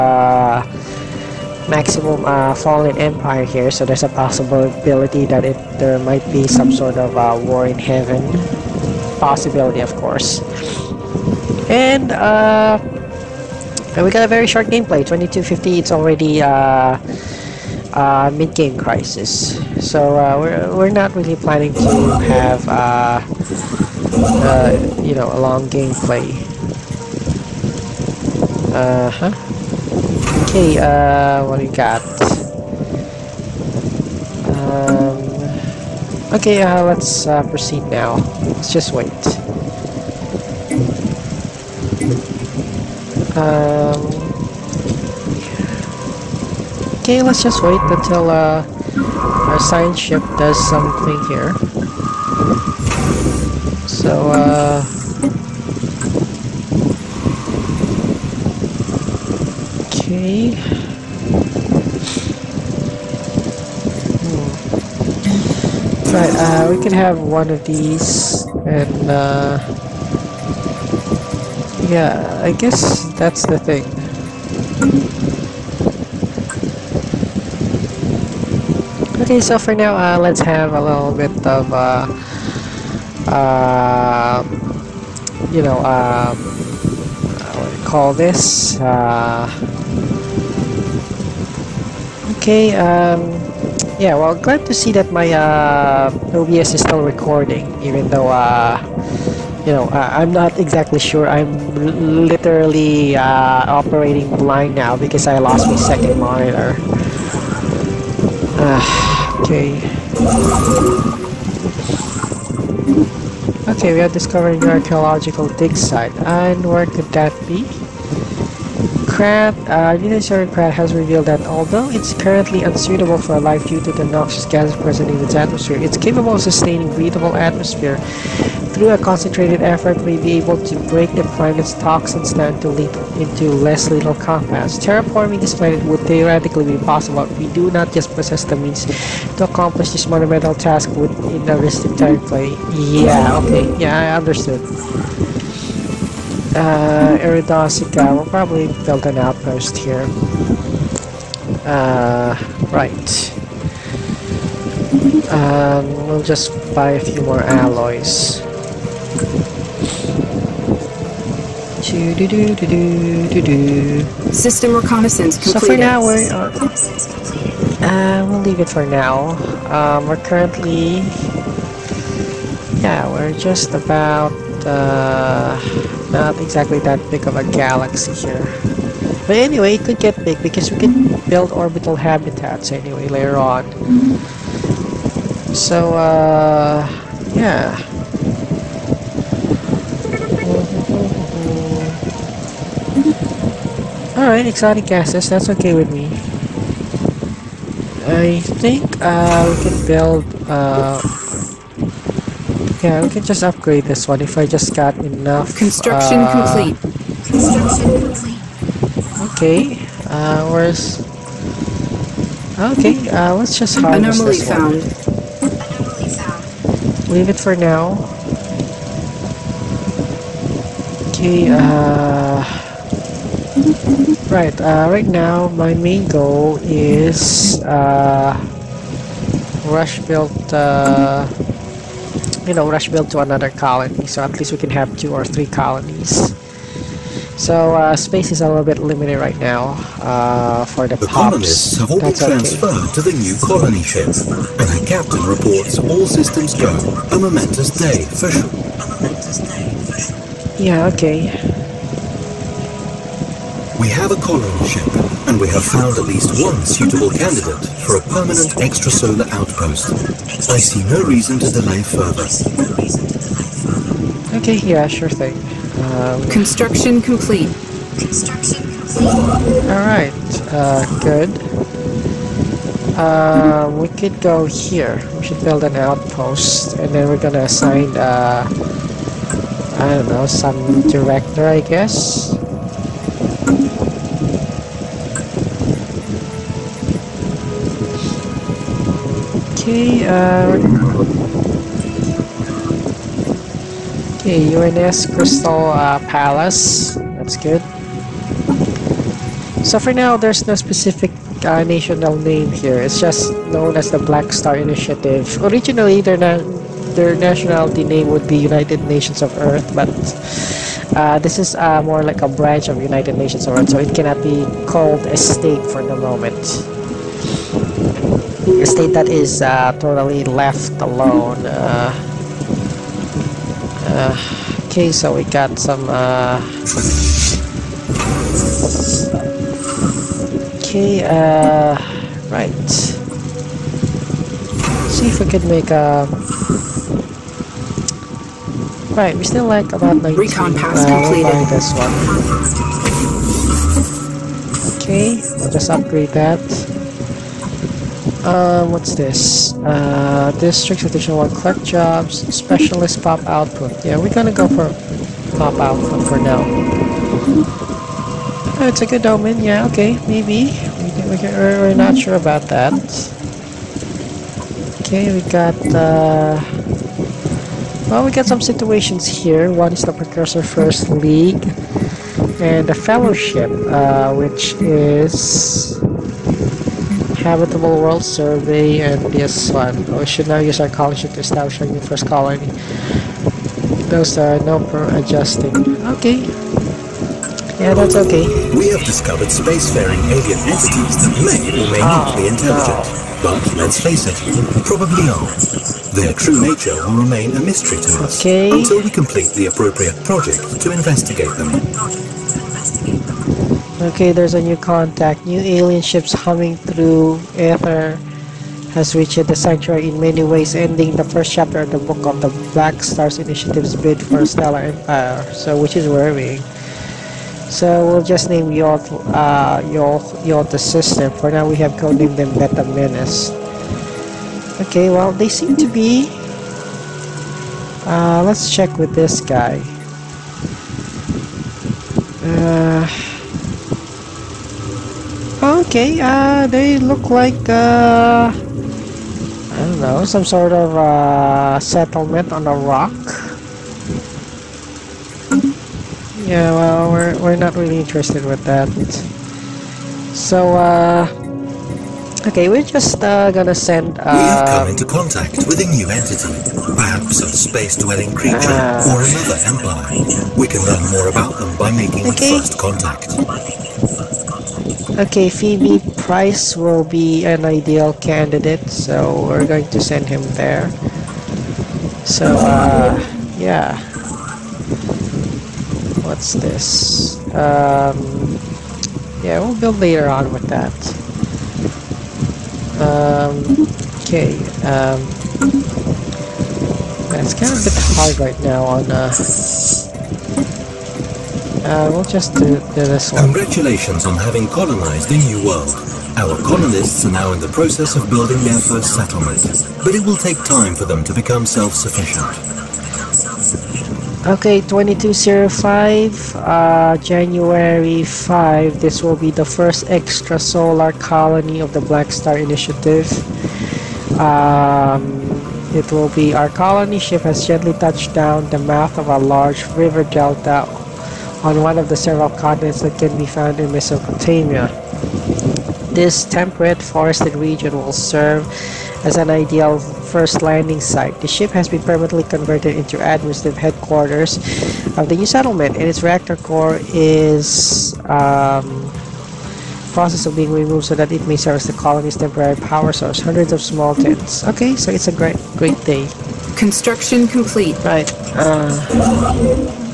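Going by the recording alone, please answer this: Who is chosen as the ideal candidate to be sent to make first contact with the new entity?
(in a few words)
Phoebe Price.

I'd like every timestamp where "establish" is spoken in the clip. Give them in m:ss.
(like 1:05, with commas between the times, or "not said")
6:21.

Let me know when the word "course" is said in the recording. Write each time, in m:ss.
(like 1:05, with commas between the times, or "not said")
0:09.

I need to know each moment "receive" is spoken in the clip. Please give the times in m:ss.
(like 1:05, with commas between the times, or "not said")
not said.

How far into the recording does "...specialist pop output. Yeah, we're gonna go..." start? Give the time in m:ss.
5:52.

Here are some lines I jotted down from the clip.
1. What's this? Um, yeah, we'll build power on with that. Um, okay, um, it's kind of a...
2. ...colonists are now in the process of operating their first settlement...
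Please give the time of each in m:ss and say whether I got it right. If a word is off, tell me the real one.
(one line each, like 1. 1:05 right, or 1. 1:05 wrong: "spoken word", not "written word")
1. 7:56 wrong: "later", not "power"
2. 8:16 wrong: "building", not "operating".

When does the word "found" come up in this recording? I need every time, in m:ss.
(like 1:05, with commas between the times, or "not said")
3:34, 4:15, 8:43.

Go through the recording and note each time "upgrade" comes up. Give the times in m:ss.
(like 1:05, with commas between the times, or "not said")
3:23, 5:45.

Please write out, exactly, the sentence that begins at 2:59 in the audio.
But anyway, it could get big because we can build orbital habitats anyway later on.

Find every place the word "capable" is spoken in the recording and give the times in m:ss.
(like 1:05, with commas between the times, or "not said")
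2:05.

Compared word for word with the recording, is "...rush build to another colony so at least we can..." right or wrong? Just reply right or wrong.
right.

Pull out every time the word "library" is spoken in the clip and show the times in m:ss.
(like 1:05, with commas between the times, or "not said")
not said.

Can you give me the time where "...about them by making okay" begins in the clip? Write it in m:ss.
7:41.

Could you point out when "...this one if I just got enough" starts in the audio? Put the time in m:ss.
3:23.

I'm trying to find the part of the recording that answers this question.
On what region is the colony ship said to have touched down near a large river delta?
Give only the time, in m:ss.
8:43.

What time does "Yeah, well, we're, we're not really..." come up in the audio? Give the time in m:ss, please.
7:26.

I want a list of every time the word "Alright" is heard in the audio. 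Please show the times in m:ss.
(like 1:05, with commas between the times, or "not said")
3:14, 4:29.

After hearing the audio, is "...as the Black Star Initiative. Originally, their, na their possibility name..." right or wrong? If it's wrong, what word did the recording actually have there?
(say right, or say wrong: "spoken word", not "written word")
wrong: "nationality", not "possibility".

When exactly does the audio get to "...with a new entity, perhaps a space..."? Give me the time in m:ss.
7:35.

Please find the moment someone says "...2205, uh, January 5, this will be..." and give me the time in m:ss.
8:24.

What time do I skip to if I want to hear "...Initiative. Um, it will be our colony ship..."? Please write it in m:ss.
8:32.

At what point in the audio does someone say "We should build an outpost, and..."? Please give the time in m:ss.
4:35.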